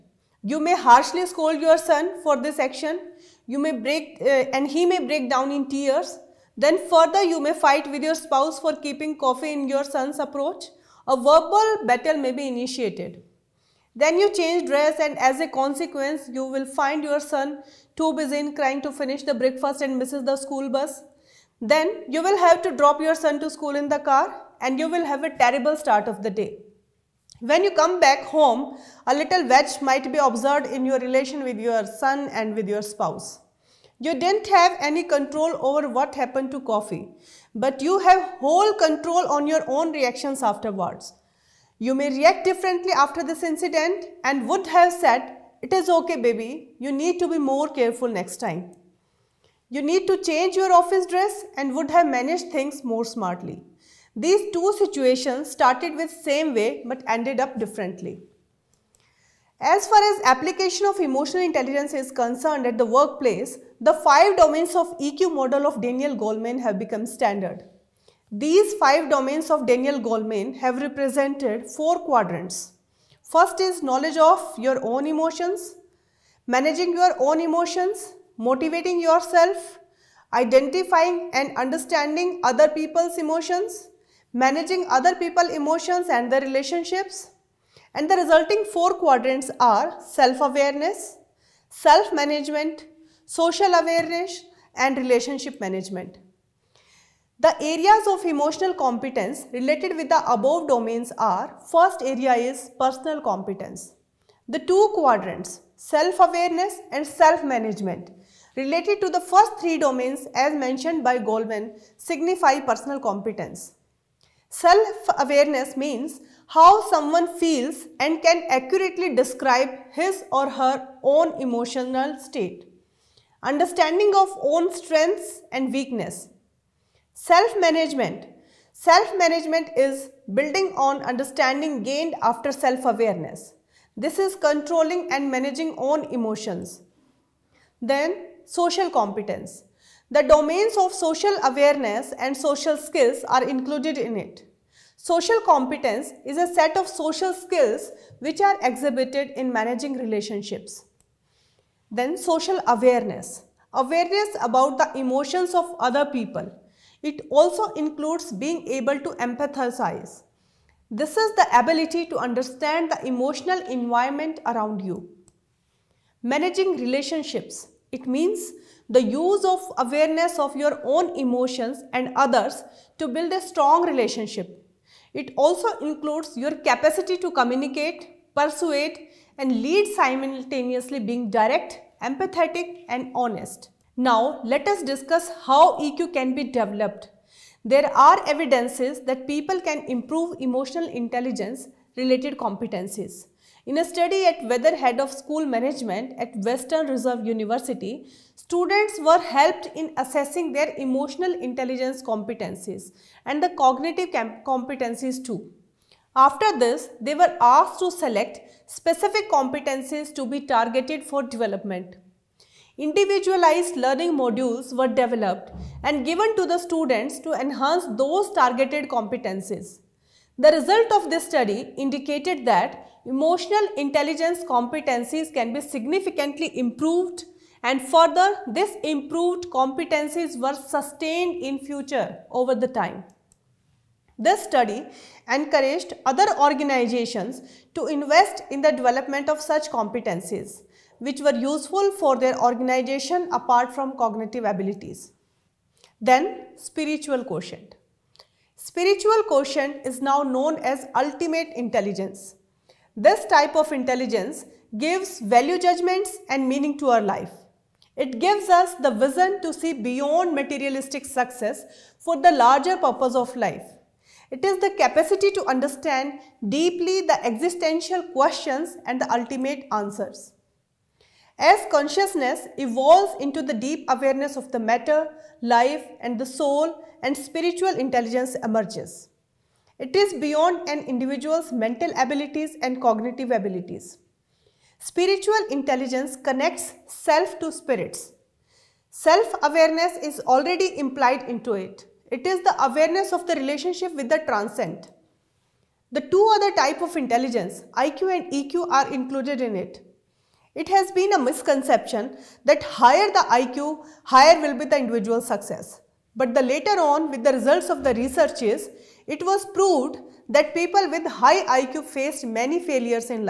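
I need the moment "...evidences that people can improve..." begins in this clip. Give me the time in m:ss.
3:08.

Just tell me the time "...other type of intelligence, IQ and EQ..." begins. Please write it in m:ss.
4:56.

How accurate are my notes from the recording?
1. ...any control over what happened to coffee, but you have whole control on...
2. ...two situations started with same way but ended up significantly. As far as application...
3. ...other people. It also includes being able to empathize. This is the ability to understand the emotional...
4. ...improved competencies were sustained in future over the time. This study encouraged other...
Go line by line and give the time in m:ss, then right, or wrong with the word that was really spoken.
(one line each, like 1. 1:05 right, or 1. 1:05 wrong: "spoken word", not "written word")
1. 0:34 right
2. 0:54 wrong: "differently", not "significantly"
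3. 2:35 right
4. 3:48 right.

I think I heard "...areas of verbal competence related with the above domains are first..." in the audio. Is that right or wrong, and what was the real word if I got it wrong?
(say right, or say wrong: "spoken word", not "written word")
wrong: "emotional", not "verbal".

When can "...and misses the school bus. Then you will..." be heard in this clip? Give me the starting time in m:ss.
0:19.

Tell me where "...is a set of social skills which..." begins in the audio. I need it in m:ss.
2:26.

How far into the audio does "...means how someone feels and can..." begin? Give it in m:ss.
1:55.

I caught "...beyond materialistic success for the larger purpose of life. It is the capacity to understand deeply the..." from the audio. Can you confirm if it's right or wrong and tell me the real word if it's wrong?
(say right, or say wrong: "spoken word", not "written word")
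right.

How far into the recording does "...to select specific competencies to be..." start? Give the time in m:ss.
3:27.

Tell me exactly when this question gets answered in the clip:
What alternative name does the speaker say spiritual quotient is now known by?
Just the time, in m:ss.
4:10.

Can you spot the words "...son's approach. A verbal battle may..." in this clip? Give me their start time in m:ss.
0:09.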